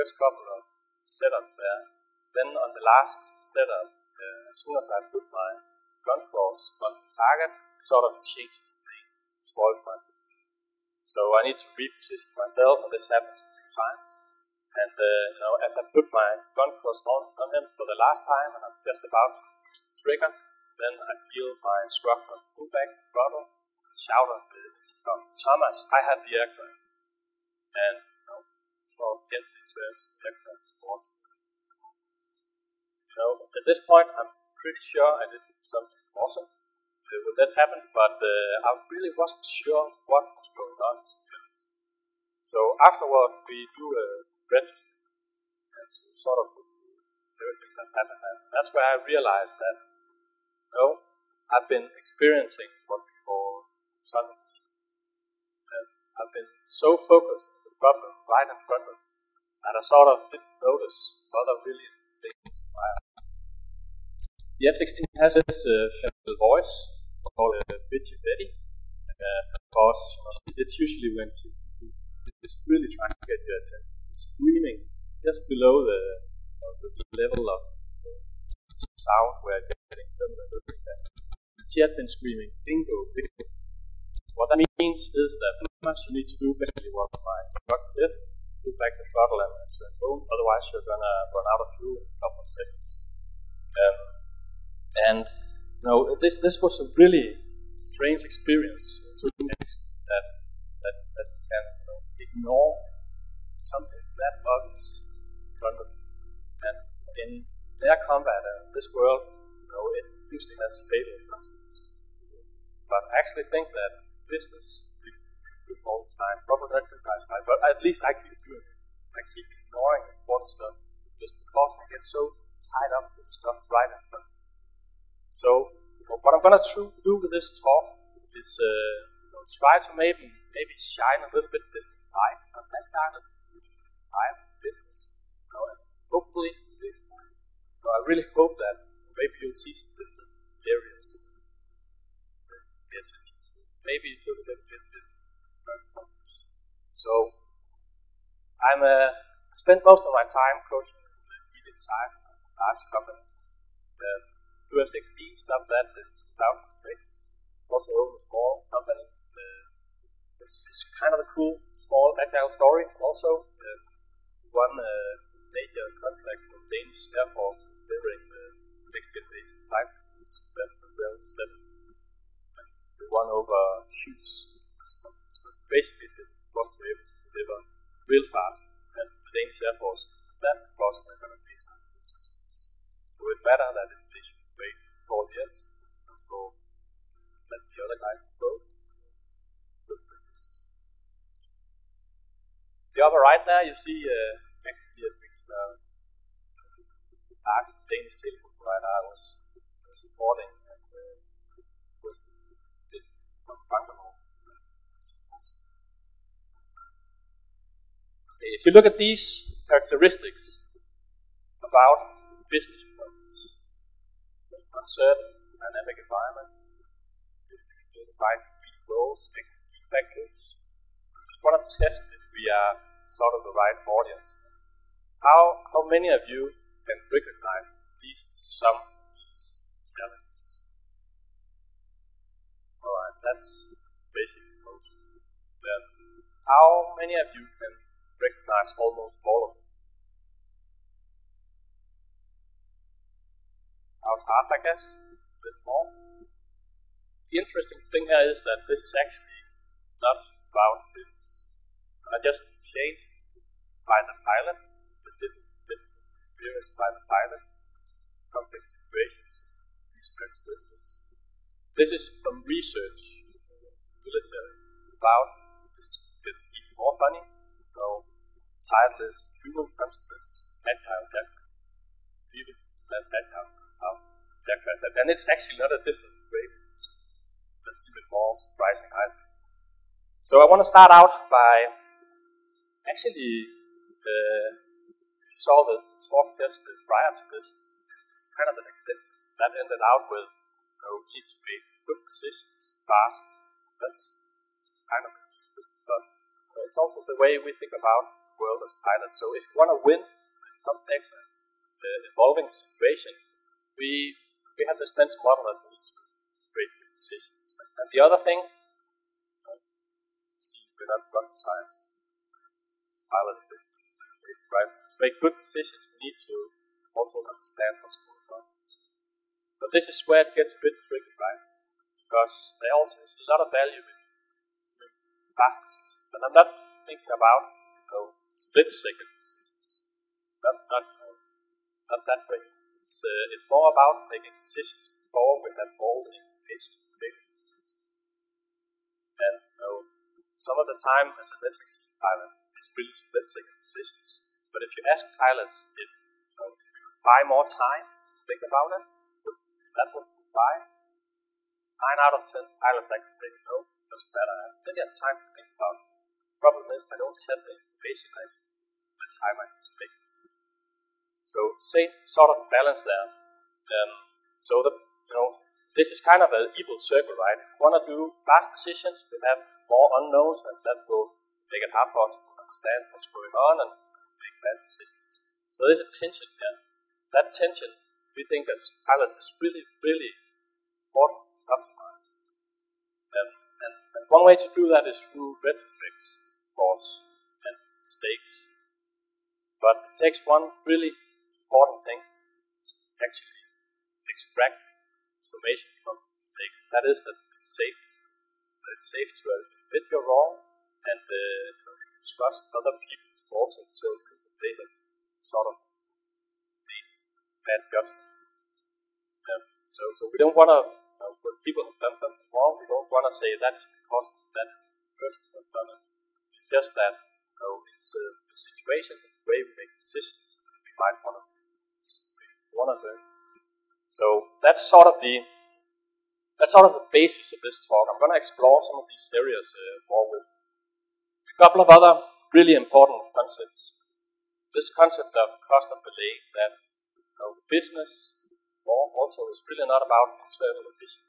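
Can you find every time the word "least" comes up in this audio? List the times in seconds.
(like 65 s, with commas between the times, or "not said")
117 s, 228 s.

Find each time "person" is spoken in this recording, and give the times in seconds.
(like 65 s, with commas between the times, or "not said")
414 s.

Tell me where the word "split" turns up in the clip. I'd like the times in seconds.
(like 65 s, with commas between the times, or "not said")
328 s, 342 s.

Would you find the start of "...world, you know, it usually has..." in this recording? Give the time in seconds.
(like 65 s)
108 s.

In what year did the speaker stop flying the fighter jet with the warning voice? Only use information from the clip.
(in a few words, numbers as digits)
2006.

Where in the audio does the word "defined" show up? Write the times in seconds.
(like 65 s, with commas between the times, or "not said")
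217 s.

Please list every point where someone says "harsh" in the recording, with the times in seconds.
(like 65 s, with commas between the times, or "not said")
not said.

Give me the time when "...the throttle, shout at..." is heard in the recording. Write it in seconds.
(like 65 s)
22 s.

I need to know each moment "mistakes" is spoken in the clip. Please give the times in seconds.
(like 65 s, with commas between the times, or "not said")
387 s, 396 s.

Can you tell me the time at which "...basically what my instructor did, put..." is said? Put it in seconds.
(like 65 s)
86 s.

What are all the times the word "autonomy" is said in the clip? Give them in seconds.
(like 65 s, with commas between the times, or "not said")
54 s.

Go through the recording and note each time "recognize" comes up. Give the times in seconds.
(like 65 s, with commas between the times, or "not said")
227 s, 238 s.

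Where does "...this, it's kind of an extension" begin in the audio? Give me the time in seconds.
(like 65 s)
287 s.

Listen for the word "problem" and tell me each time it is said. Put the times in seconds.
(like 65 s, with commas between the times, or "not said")
57 s, 212 s, 356 s.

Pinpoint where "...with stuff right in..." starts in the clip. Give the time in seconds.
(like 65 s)
123 s.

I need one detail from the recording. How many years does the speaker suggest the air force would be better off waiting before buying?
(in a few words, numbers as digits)
4.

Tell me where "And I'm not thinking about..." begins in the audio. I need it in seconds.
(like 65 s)
326 s.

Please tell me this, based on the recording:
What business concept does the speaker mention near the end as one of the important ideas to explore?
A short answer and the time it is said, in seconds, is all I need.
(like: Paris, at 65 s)
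cost of delay, at 435 s.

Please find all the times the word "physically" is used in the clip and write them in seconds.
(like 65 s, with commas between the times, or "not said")
not said.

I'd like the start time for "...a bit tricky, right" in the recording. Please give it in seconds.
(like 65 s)
320 s.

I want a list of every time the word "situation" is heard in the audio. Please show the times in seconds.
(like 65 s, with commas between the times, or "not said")
258 s, 302 s, 418 s.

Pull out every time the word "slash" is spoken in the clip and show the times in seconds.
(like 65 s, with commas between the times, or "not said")
not said.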